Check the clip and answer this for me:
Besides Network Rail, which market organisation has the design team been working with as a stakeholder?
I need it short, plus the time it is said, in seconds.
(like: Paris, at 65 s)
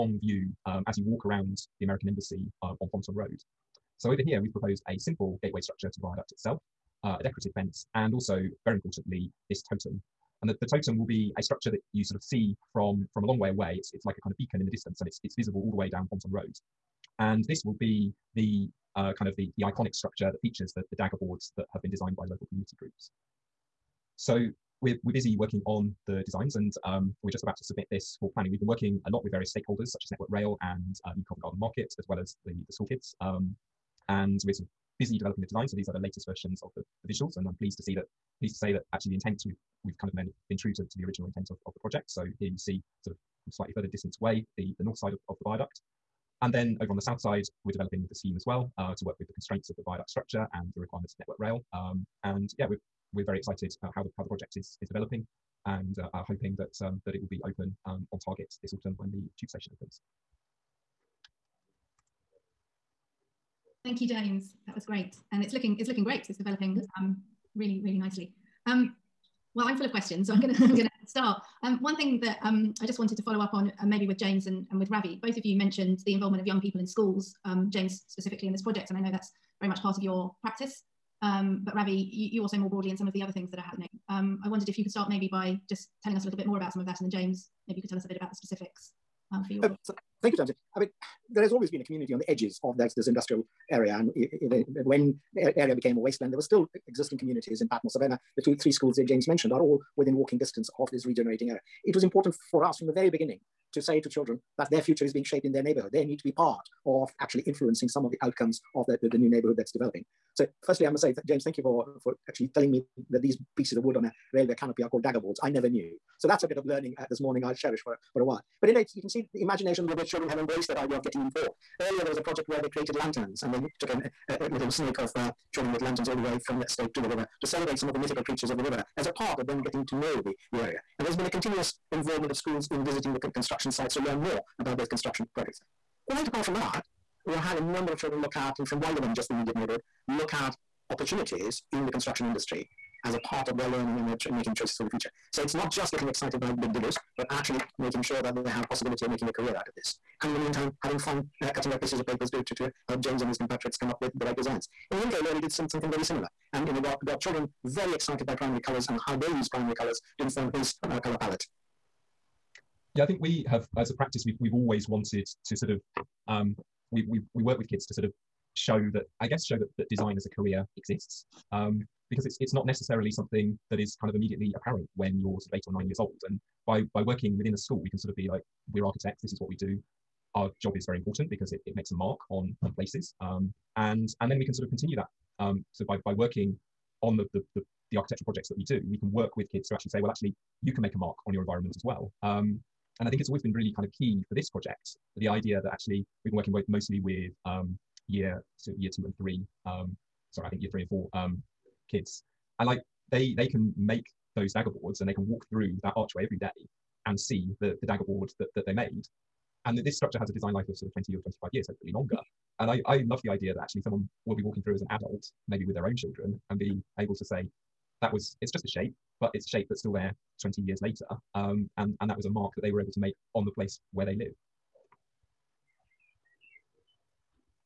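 New Covent Garden Market, at 31 s.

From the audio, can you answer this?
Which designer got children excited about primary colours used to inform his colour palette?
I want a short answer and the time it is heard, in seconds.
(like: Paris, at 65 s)
Yinka Ilori, at 154 s.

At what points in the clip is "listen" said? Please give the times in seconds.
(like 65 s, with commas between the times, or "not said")
not said.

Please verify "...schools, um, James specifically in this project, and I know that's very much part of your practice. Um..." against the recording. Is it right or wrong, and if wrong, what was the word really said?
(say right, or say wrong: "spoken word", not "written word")
right.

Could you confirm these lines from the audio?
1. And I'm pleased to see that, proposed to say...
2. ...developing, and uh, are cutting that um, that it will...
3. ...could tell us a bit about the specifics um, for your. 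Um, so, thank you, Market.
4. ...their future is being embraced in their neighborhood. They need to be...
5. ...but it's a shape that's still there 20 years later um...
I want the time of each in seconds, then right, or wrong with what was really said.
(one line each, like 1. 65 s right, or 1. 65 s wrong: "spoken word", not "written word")
1. 37 s wrong: "pleased", not "proposed"
2. 54 s wrong: "hoping", not "cutting"
3. 87 s wrong: "James", not "Market"
4. 104 s wrong: "shaped", not "embraced"
5. 219 s right.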